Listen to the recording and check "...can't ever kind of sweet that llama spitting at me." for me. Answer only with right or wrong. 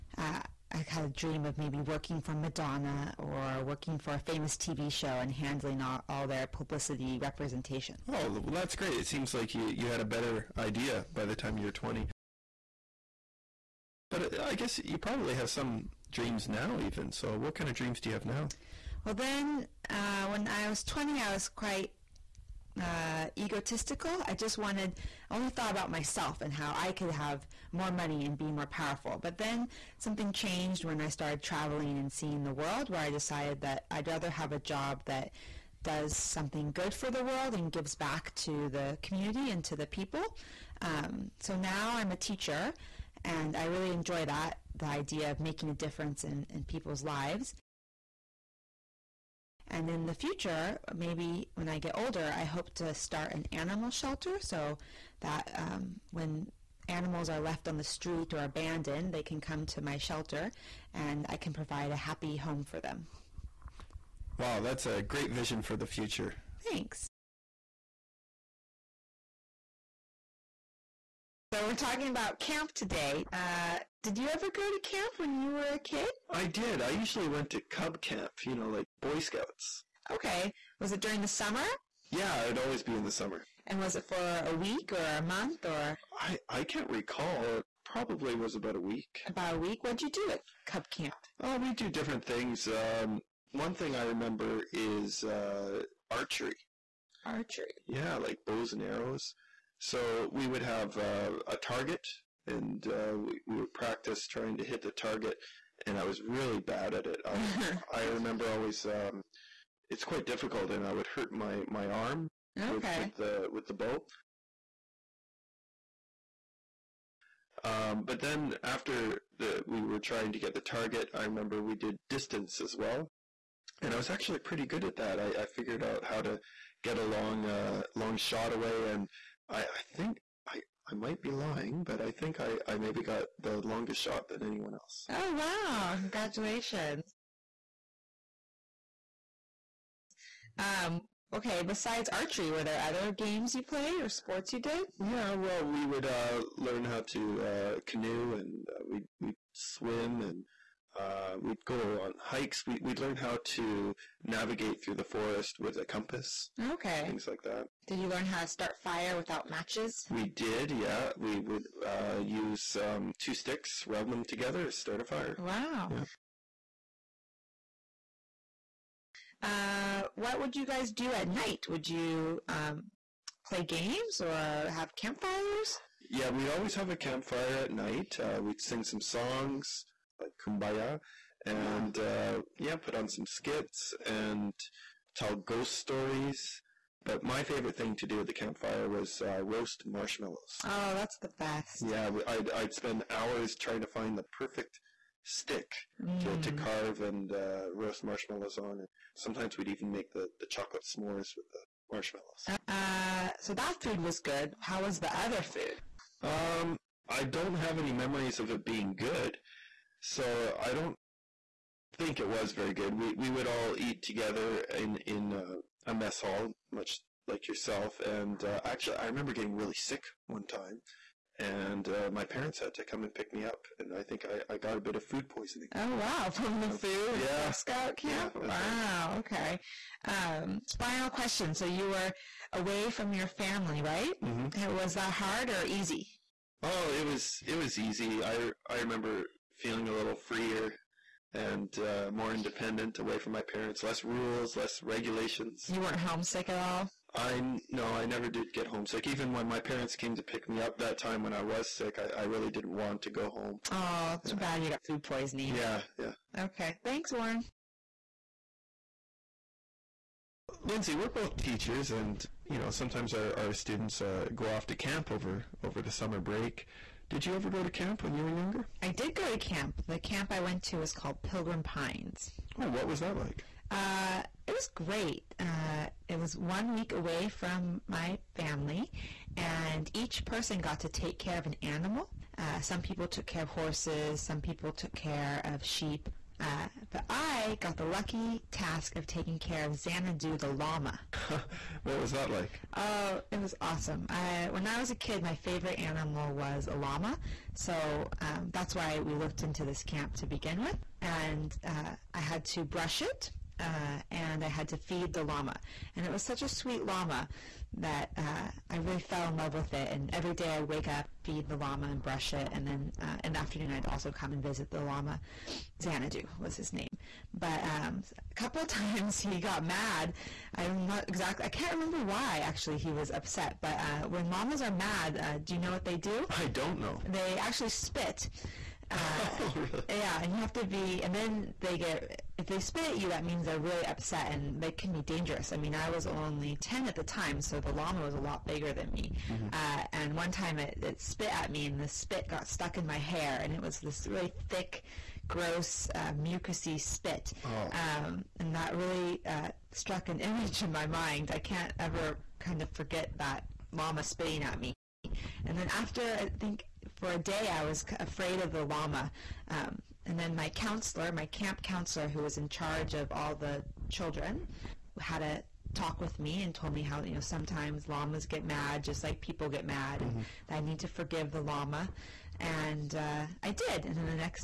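wrong.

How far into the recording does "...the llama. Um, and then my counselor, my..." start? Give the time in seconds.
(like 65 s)
358 s.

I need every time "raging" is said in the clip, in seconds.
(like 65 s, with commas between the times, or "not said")
not said.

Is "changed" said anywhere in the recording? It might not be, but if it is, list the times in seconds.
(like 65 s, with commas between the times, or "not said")
30 s.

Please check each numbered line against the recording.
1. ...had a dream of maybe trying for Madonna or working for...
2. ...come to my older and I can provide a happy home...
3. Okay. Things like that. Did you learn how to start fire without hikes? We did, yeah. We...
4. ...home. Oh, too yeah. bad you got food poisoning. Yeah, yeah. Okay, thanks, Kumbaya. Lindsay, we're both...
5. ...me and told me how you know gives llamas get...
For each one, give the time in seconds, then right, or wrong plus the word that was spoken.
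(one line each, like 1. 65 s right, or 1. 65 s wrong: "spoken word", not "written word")
1. 0 s wrong: "working", not "trying"
2. 59 s wrong: "shelter", not "older"
3. 156 s wrong: "matches", not "hikes"
4. 253 s wrong: "Warren", not "Kumbaya"
5. 366 s wrong: "sometimes", not "gives".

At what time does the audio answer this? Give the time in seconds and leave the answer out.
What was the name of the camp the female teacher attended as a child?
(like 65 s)
271 s.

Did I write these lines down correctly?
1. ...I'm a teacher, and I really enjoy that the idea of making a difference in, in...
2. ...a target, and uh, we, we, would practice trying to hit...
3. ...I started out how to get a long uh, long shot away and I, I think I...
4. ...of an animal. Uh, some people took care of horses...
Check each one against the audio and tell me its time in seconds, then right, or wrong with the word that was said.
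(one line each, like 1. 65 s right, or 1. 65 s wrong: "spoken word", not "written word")
1. 41 s right
2. 101 s right
3. 125 s wrong: "figured", not "started"
4. 281 s right.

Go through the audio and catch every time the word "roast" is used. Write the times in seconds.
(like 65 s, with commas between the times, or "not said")
189 s, 197 s.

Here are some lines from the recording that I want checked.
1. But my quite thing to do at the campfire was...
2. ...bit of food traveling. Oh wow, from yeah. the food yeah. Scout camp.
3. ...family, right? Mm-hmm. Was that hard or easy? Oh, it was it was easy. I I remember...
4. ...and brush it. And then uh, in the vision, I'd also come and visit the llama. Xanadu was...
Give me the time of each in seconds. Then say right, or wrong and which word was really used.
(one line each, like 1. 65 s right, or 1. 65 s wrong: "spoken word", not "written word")
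1. 187 s wrong: "favorite", not "quite"
2. 224 s wrong: "poisoning", not "traveling"
3. 233 s right
4. 311 s wrong: "afternoon", not "vision".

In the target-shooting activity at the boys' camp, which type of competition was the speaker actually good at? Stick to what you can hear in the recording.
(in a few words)
Distance.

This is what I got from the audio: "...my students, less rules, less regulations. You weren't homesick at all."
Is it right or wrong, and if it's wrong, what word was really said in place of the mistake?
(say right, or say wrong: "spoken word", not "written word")
wrong: "parents", not "students".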